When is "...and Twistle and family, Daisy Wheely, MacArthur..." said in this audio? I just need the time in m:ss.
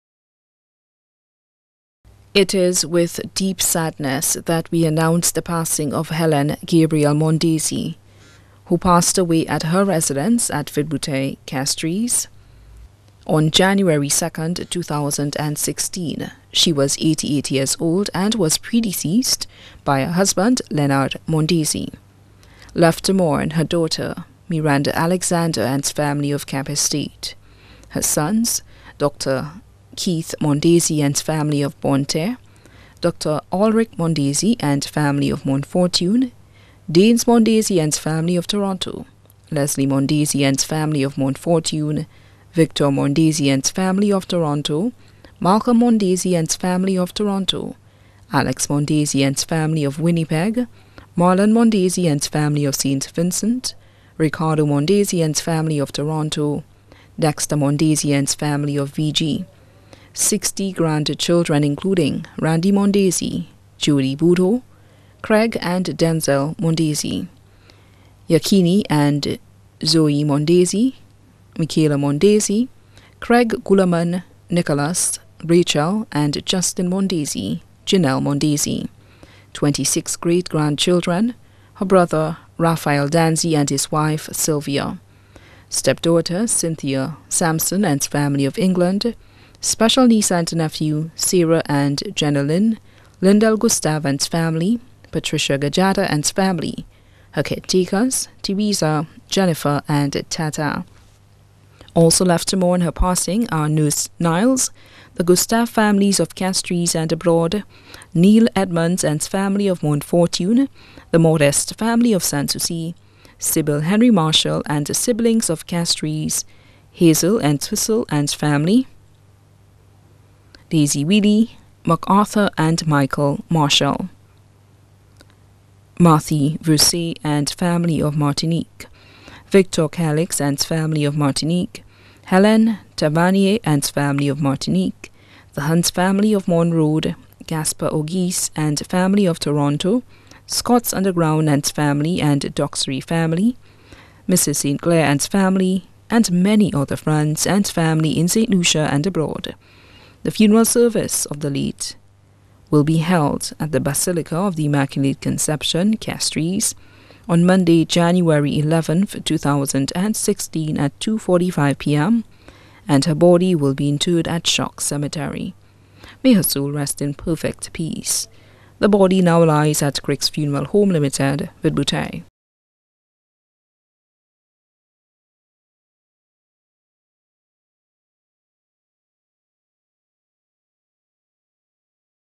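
1:57.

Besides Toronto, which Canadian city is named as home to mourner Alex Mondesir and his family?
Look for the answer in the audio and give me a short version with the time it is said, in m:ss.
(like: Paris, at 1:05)
Winnipeg, at 0:49.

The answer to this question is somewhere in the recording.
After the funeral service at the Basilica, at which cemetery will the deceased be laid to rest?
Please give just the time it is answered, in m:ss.
2:44.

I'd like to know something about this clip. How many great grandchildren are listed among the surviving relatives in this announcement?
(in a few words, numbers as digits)
26.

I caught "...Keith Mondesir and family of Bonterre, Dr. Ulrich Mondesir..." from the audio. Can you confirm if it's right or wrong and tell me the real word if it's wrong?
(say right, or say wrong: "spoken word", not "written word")
right.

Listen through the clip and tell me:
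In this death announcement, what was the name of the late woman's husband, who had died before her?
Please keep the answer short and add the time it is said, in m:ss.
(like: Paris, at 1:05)
Leonard Mondesir, at 0:20.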